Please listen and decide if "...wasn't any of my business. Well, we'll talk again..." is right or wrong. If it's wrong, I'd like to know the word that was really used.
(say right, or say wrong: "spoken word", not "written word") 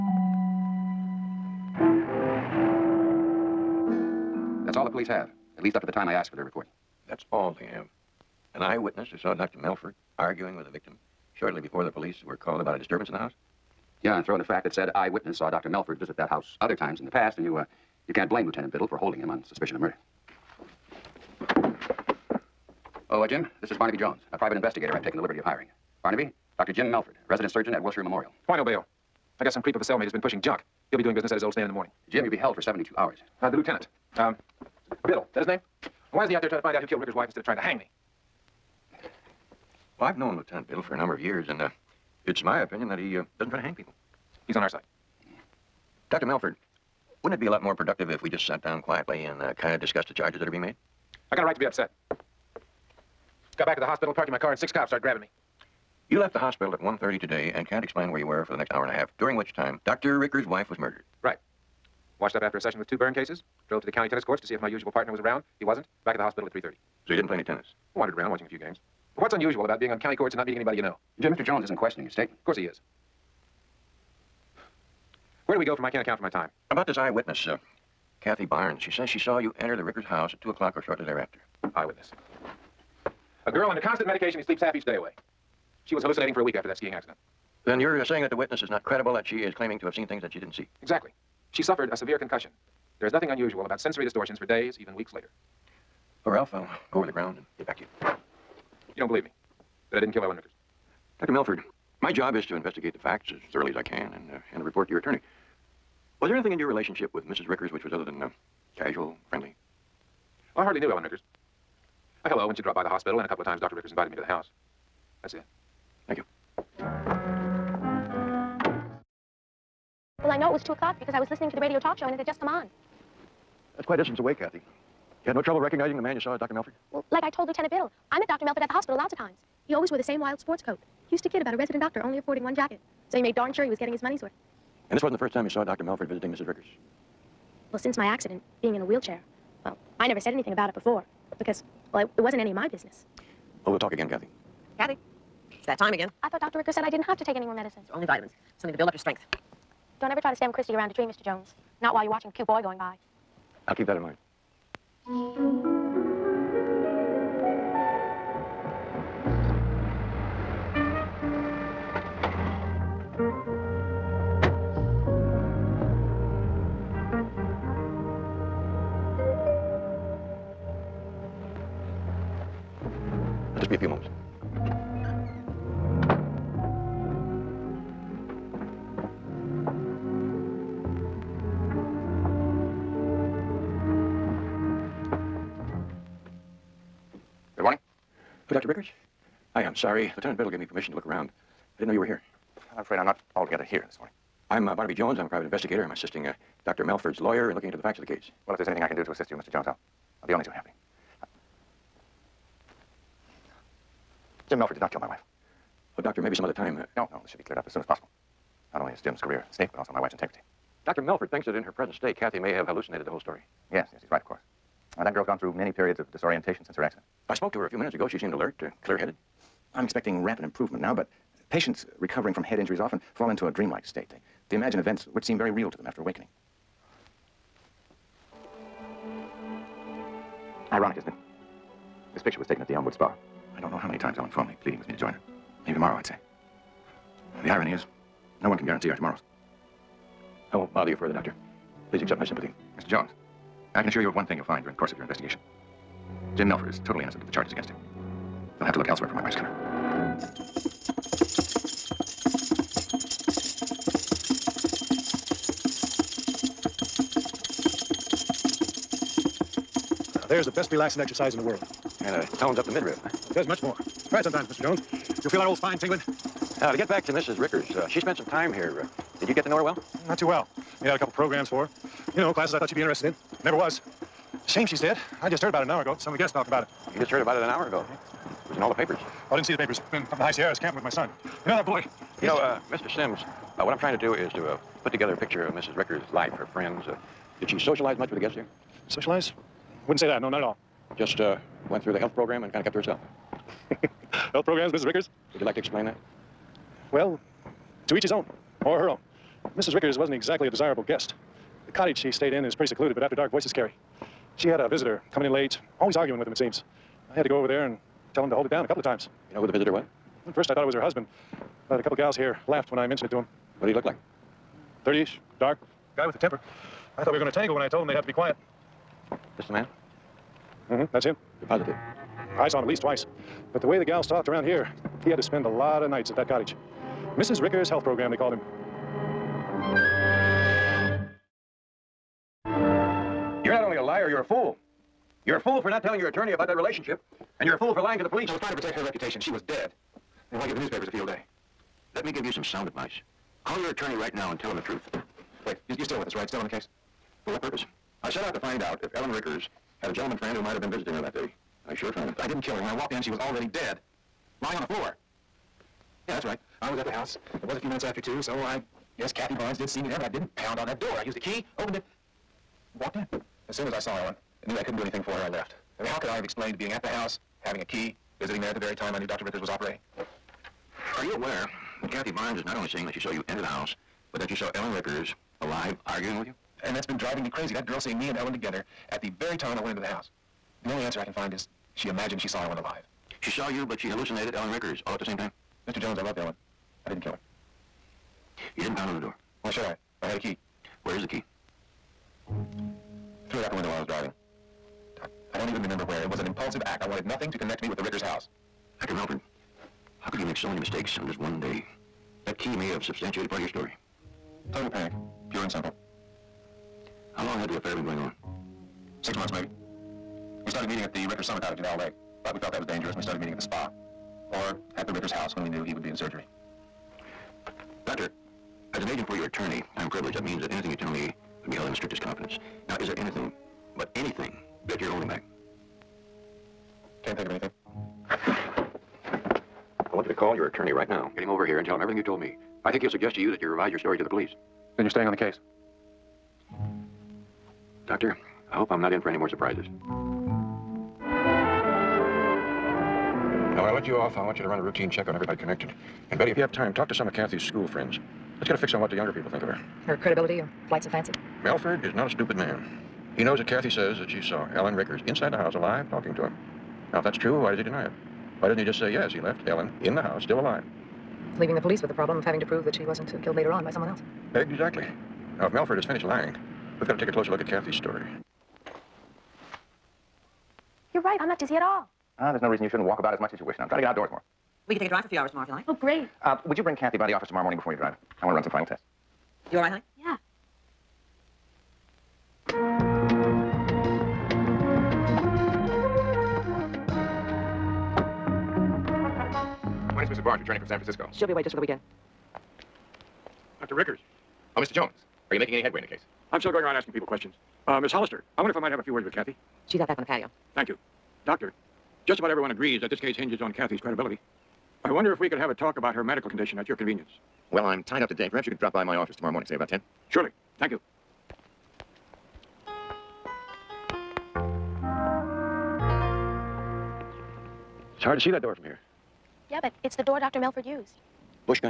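right.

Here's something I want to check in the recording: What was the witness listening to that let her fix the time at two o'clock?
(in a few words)
radio talk show.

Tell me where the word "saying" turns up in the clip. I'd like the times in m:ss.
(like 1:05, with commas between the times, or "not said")
1:28, 6:12.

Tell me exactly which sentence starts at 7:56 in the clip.
Uh, would you bring Kathy by the office tomorrow morning before you drive?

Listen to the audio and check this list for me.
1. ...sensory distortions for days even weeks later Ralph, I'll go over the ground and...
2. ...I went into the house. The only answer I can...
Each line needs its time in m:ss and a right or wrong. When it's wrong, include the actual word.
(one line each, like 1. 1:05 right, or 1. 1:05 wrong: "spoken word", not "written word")
1. 1:33 right
2. 6:19 right.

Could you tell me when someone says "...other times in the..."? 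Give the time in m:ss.
0:16.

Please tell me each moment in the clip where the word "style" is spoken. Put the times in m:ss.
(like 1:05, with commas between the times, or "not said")
not said.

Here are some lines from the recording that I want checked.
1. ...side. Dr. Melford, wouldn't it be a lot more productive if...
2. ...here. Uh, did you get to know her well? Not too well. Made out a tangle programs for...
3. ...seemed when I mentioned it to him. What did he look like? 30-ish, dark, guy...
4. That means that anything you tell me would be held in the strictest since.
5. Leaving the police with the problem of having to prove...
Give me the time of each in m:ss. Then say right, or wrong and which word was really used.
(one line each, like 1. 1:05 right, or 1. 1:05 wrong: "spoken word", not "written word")
1. 0:44 right
2. 4:28 wrong: "couple", not "tangle"
3. 5:12 wrong: "laughed", not "seemed"
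4. 7:00 wrong: "confidence", not "since"
5. 7:41 right.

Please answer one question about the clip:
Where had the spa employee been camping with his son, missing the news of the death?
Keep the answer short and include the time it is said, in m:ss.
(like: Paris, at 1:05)
High Sierras, at 4:40.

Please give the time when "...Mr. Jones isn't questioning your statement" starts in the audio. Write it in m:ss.
1:11.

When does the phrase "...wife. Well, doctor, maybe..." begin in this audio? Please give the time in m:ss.
3:25.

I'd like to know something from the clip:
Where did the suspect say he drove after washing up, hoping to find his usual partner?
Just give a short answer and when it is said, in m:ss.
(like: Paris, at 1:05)
county tennis courts, at 1:03.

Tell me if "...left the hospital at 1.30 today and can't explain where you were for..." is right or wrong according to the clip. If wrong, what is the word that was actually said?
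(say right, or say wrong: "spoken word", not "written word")
right.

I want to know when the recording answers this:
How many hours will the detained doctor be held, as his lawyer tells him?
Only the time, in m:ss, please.
0:32.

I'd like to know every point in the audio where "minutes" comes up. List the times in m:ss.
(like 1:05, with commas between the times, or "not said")
3:37, 5:57.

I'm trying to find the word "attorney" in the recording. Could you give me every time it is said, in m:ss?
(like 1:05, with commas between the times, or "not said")
1:44, 5:36, 5:43, 6:59, 7:10.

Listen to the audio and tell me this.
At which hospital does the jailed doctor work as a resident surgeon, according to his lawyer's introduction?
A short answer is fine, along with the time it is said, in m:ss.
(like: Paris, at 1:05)
Wilshire Memorial, at 0:27.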